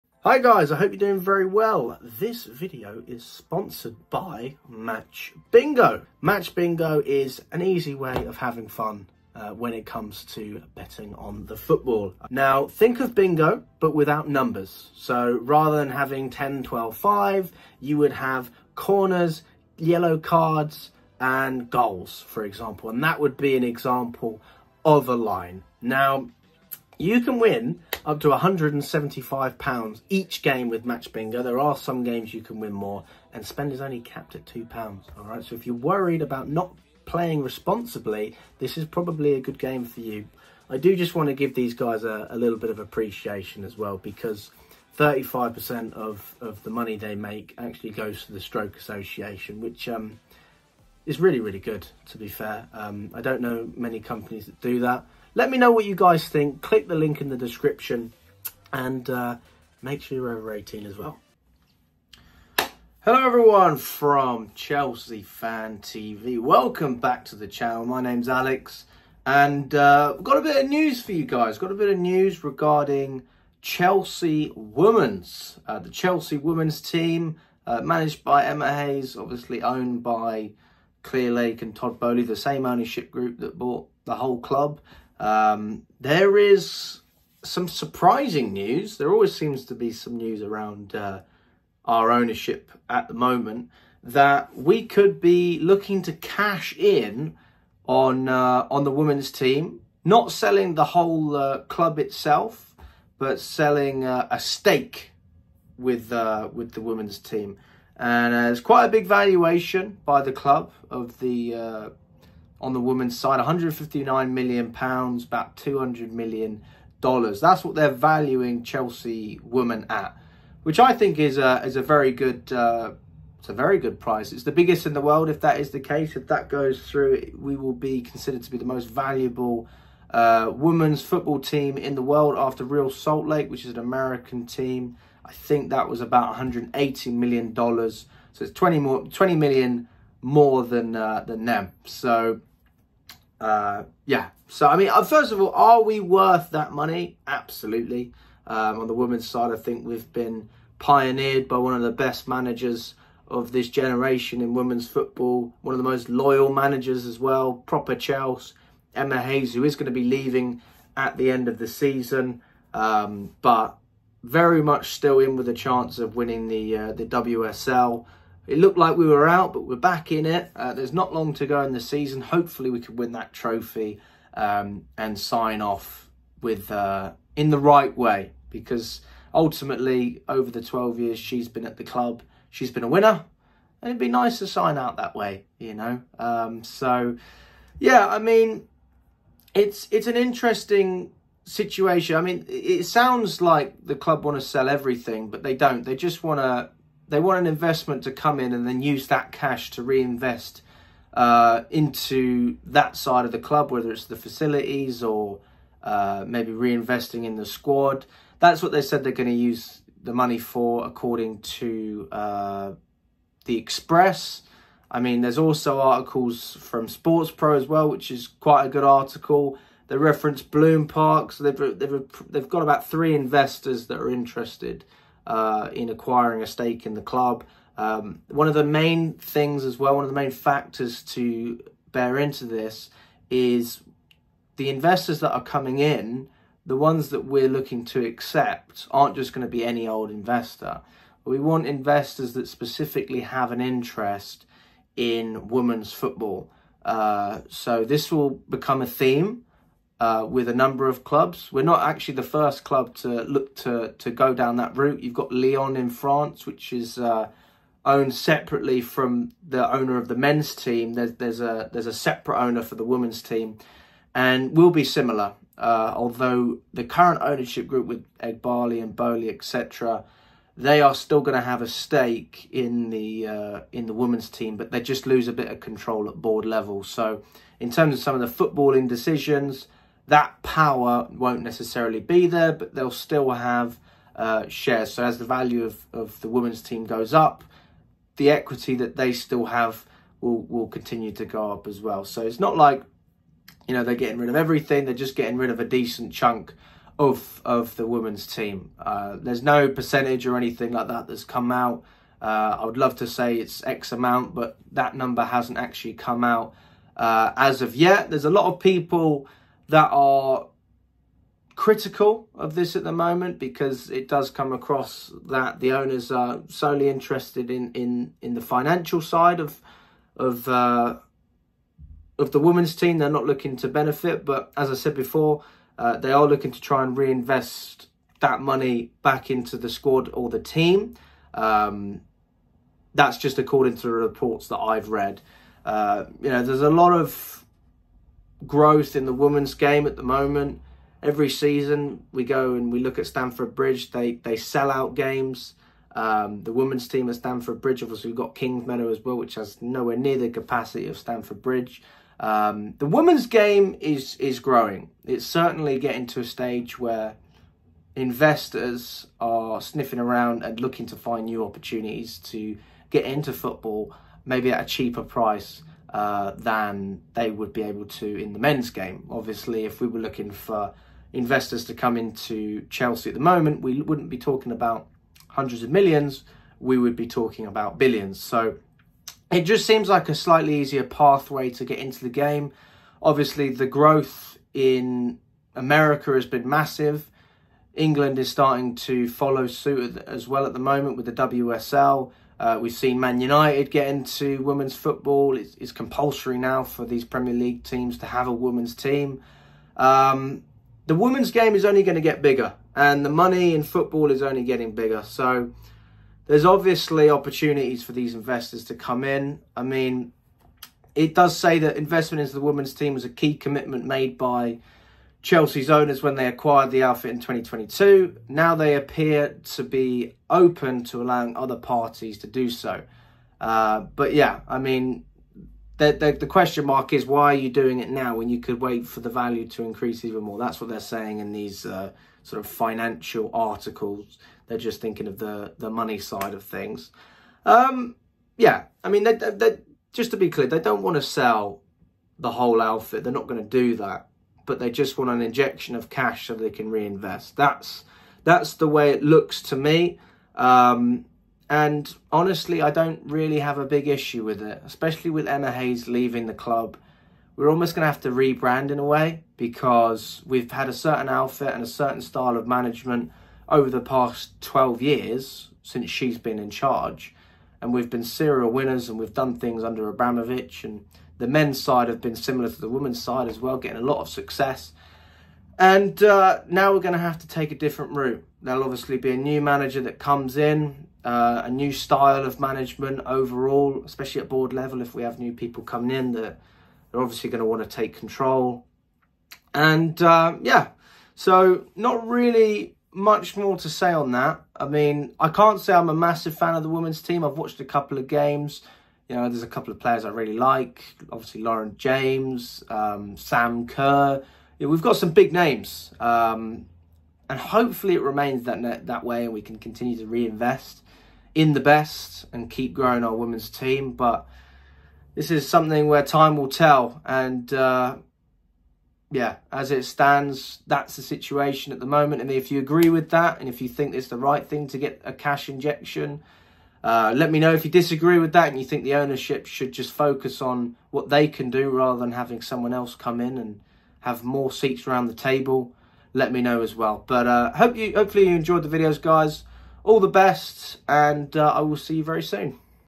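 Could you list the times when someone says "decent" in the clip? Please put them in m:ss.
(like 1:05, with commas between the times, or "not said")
4:55.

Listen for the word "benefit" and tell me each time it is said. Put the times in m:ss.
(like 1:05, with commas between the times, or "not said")
5:23.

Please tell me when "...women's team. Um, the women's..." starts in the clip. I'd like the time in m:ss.
6:38.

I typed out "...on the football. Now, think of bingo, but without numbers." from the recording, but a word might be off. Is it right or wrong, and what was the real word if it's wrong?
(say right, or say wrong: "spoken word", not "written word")
right.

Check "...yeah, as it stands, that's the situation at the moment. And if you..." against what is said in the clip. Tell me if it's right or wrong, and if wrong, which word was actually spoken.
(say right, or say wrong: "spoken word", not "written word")
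right.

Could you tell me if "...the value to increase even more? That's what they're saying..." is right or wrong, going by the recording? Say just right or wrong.
right.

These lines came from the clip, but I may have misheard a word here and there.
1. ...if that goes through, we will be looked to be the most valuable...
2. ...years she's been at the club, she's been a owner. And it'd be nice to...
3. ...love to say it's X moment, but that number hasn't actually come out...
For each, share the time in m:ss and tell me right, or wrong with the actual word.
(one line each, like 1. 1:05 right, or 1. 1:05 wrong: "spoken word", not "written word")
1. 2:06 wrong: "considered", not "looked"
2. 3:00 wrong: "winner", not "owner"
3. 5:02 wrong: "amount", not "moment".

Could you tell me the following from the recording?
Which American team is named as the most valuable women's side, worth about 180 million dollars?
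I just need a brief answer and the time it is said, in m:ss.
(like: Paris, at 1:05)
Real Salt Lake, at 2:12.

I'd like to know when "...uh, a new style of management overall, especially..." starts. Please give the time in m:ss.
8:01.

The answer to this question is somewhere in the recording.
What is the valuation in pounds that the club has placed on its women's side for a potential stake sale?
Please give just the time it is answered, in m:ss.
1:53.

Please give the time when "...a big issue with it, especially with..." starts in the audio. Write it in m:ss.
7:33.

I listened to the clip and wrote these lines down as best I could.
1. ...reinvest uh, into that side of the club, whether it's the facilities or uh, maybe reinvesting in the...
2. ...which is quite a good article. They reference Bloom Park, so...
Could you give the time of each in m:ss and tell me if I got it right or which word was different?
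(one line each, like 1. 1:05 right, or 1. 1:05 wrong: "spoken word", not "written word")
1. 3:19 right
2. 3:37 right.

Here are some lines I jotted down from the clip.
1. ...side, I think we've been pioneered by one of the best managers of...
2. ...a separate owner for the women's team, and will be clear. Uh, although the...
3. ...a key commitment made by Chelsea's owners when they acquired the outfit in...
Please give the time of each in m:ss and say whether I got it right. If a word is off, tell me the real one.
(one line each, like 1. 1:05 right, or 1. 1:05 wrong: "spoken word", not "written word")
1. 2:29 right
2. 4:21 wrong: "similar", not "clear"
3. 6:53 right.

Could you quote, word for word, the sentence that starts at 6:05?
Uh, than they would be able to in the men's game.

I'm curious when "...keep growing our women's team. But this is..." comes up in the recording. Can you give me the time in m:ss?
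8:32.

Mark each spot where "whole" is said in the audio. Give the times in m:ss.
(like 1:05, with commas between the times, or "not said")
1:24, 1:40, 7:22.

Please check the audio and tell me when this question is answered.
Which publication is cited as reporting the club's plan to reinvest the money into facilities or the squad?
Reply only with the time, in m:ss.
3:33.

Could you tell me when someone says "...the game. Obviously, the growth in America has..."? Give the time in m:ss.
6:21.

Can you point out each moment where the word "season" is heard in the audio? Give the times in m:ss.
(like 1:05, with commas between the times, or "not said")
2:41, 2:51, 5:41.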